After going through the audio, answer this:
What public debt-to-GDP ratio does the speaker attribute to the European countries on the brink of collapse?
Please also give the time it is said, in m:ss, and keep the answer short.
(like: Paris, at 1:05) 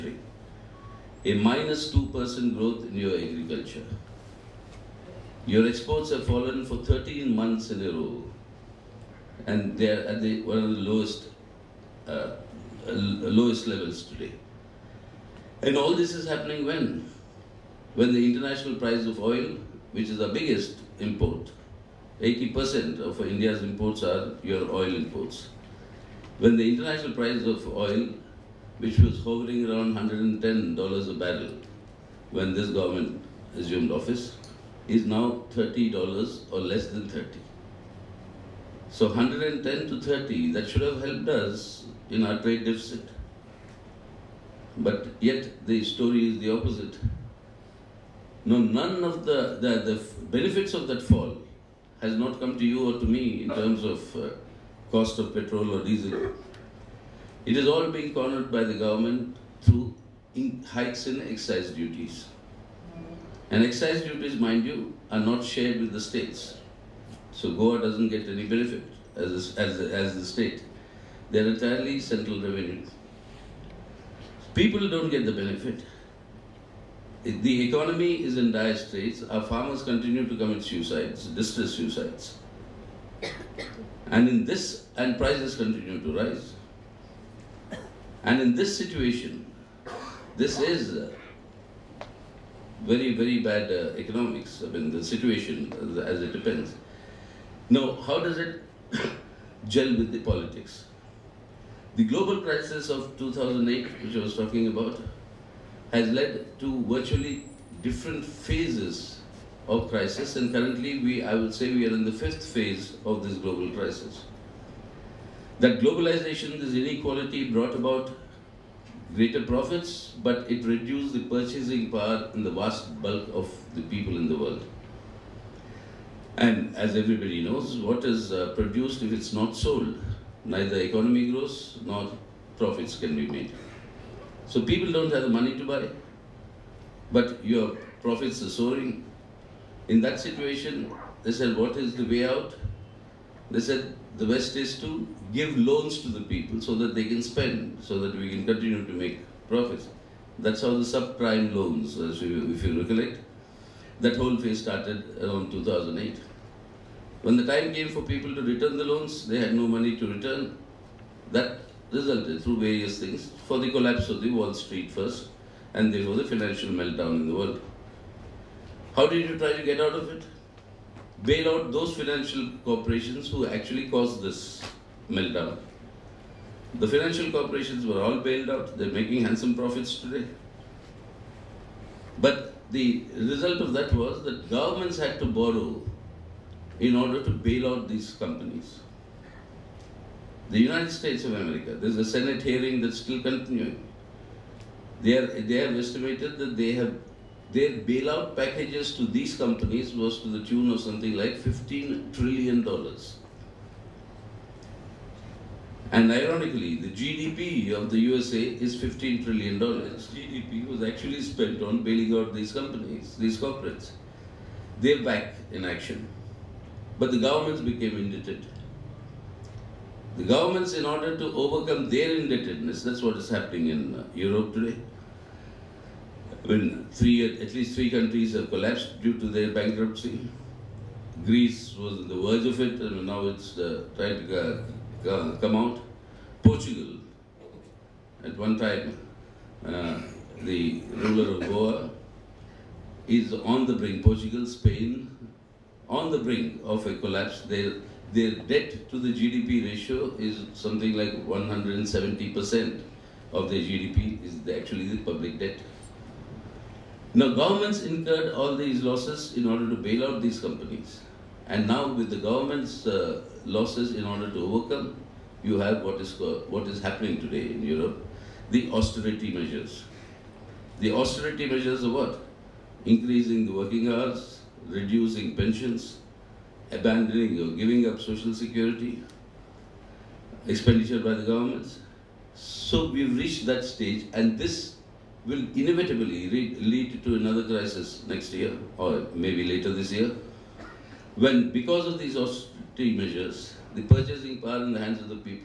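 170%, at 4:11.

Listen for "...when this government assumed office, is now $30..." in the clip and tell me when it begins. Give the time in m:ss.
0:32.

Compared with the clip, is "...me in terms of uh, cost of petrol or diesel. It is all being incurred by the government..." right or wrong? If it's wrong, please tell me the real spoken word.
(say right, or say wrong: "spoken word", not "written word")
wrong: "cornered", not "incurred".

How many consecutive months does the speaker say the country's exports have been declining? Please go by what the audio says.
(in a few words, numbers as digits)
13.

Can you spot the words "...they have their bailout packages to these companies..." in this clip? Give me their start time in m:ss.
3:16.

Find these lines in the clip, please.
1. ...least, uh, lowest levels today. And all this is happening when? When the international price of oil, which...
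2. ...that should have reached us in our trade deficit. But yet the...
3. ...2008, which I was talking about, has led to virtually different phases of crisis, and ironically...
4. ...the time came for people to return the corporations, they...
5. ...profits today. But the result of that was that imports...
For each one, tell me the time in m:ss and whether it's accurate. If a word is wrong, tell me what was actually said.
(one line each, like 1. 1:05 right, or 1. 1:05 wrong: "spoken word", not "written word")
1. 0:10 wrong: "lowest", not "least"
2. 0:40 wrong: "helped", not "reached"
3. 1:43 wrong: "currently", not "ironically"
4. 2:37 wrong: "loans", not "corporations"
5. 2:59 wrong: "governments", not "imports".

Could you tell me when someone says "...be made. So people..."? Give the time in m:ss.
2:13.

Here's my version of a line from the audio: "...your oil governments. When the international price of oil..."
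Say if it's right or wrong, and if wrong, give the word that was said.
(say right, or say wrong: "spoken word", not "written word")
wrong: "imports", not "governments".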